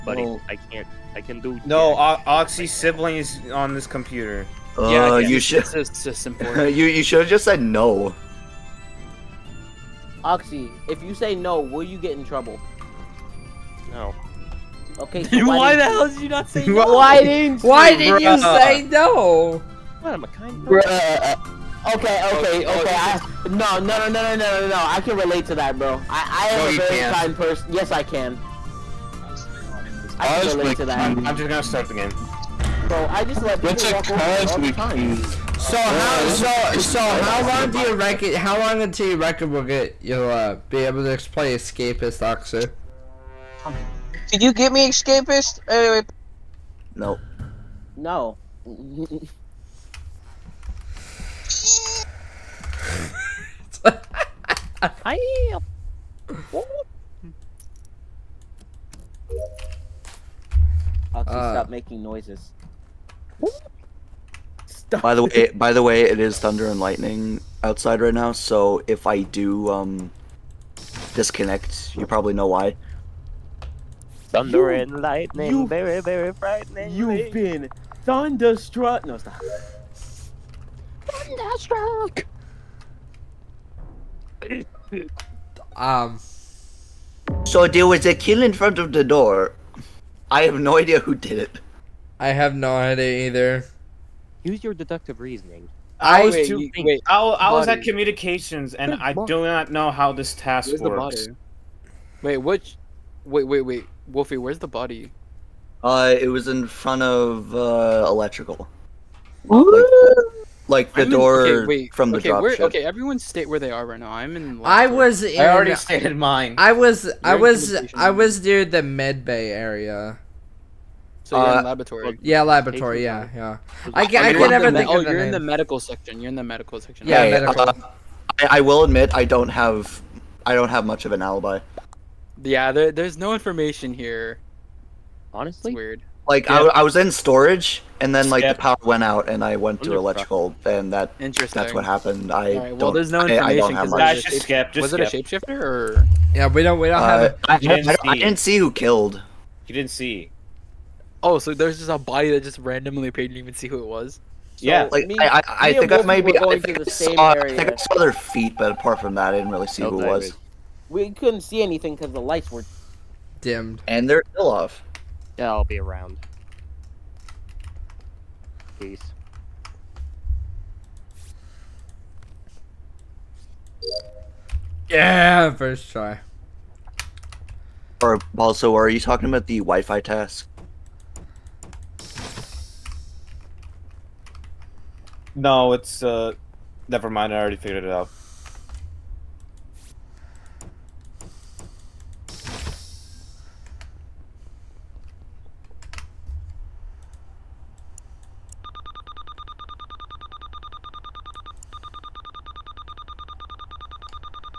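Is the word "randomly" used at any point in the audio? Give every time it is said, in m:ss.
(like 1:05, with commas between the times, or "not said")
2:32.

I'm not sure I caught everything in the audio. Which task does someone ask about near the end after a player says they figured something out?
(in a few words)
The Wi-Fi task.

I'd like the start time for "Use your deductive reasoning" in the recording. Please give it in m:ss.
1:34.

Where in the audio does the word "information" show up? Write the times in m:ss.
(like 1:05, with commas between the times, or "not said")
2:13, 2:23.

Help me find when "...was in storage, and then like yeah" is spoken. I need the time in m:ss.
2:16.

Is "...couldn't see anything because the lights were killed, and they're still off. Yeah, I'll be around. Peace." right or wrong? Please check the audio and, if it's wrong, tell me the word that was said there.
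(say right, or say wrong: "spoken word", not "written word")
wrong: "dimmed", not "killed".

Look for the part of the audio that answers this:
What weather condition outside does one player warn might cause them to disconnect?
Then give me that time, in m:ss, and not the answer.
1:06.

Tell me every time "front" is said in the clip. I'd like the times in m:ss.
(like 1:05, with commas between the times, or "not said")
1:28, 1:46.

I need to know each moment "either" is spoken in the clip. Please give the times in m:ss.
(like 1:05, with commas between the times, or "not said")
1:33.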